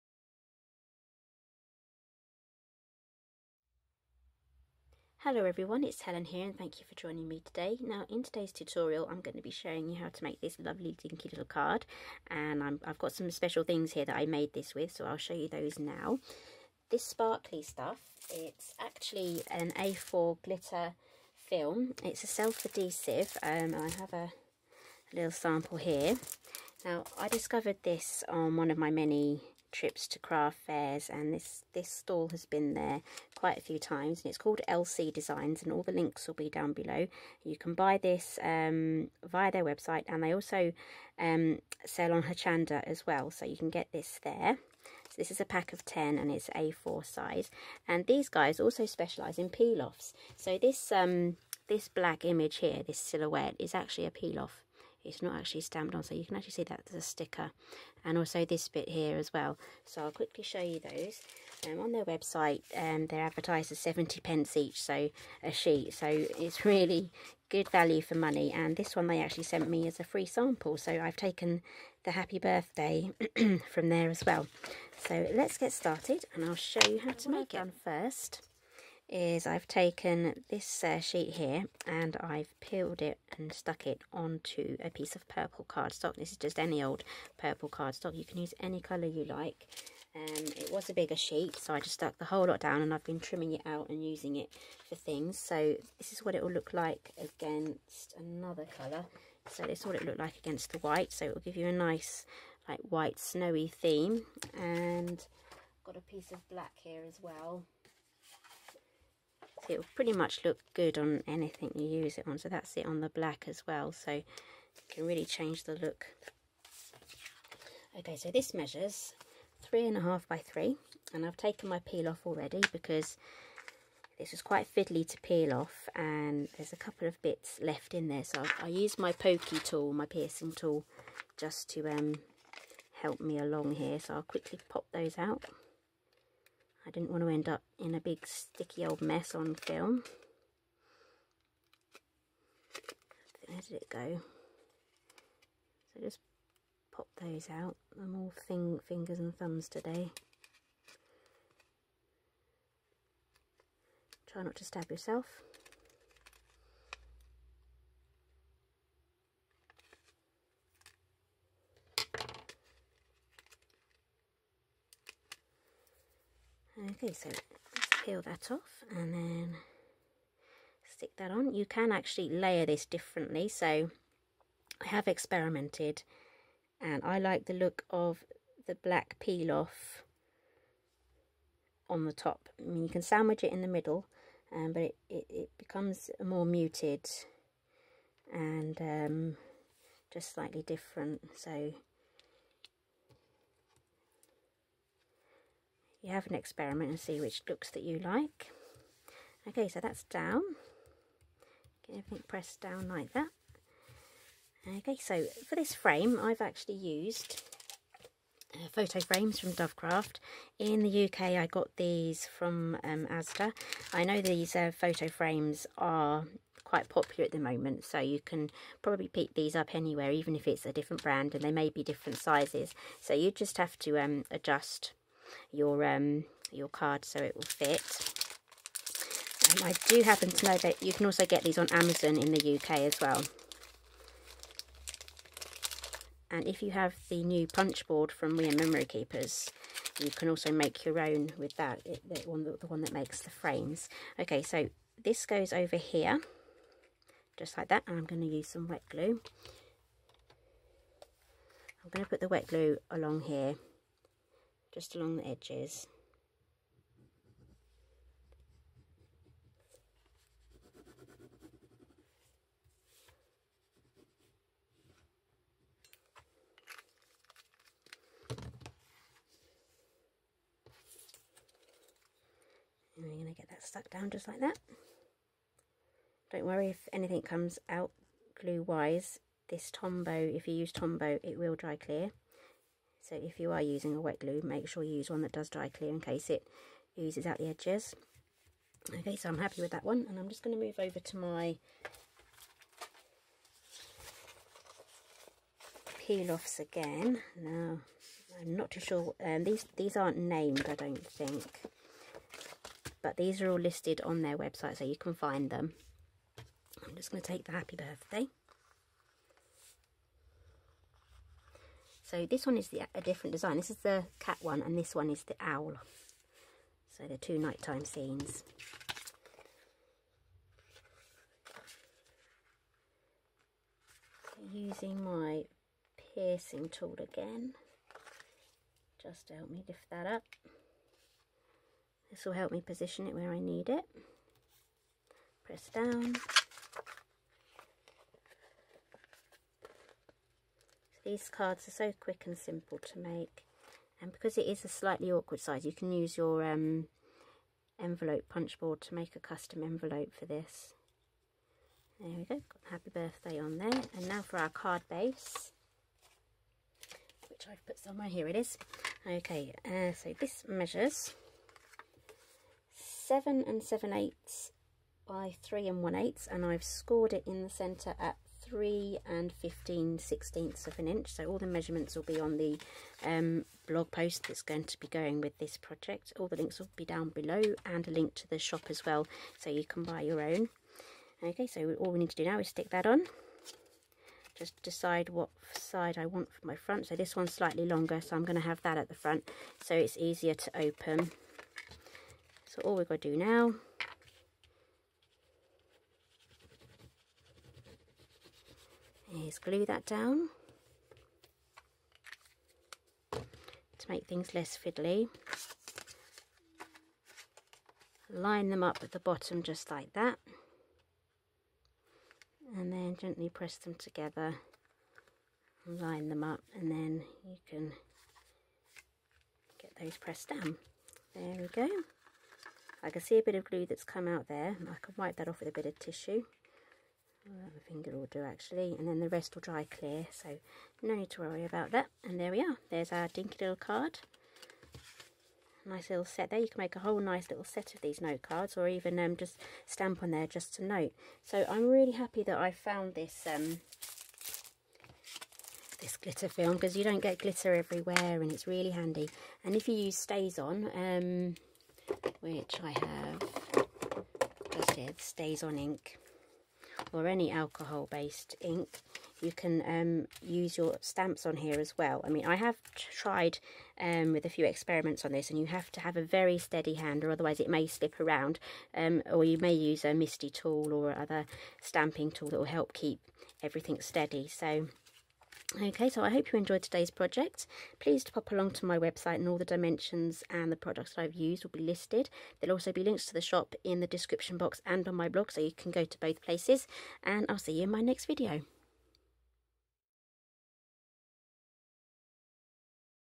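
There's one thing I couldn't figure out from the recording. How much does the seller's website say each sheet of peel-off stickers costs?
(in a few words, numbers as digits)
70 pence.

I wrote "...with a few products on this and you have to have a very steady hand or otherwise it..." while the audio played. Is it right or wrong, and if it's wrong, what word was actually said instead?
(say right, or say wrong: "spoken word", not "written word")
wrong: "experiments", not "products".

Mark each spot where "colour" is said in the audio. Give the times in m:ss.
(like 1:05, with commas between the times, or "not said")
1:28, 1:38.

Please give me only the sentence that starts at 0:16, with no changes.
This sparkly stuff, it's actually an A4 glitter film.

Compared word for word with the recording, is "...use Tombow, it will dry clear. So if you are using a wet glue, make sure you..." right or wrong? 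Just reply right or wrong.
right.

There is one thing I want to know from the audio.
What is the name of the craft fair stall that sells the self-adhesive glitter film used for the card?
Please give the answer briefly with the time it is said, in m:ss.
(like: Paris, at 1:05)
LC Designs, at 0:34.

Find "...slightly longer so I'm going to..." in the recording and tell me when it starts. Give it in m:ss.
6:27.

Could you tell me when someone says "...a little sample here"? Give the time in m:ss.
0:25.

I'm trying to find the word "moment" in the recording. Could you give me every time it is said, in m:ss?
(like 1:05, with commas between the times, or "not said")
3:37.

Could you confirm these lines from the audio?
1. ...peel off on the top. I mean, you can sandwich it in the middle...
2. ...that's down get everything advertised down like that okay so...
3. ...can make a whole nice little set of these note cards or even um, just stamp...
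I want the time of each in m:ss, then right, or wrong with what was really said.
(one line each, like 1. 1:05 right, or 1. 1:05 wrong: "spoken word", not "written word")
1. 2:59 right
2. 3:19 wrong: "pressed", not "advertised"
3. 7:16 right.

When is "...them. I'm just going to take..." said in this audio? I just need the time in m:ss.
5:05.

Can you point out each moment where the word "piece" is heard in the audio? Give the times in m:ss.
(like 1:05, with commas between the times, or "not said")
1:24, 1:46.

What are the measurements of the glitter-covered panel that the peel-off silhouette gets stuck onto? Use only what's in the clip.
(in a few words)
3 1/2 by 3.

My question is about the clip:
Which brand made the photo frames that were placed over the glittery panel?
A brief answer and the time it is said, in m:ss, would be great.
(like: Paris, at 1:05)
Dovecraft, at 3:29.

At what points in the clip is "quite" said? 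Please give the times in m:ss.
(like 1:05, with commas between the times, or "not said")
0:33, 2:04, 3:36.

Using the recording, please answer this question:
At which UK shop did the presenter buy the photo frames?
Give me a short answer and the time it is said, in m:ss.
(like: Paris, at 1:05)
Asda, at 3:33.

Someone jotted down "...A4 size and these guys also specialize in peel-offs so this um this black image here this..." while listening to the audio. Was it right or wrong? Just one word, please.
right.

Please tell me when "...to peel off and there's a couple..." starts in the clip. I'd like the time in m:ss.
2:05.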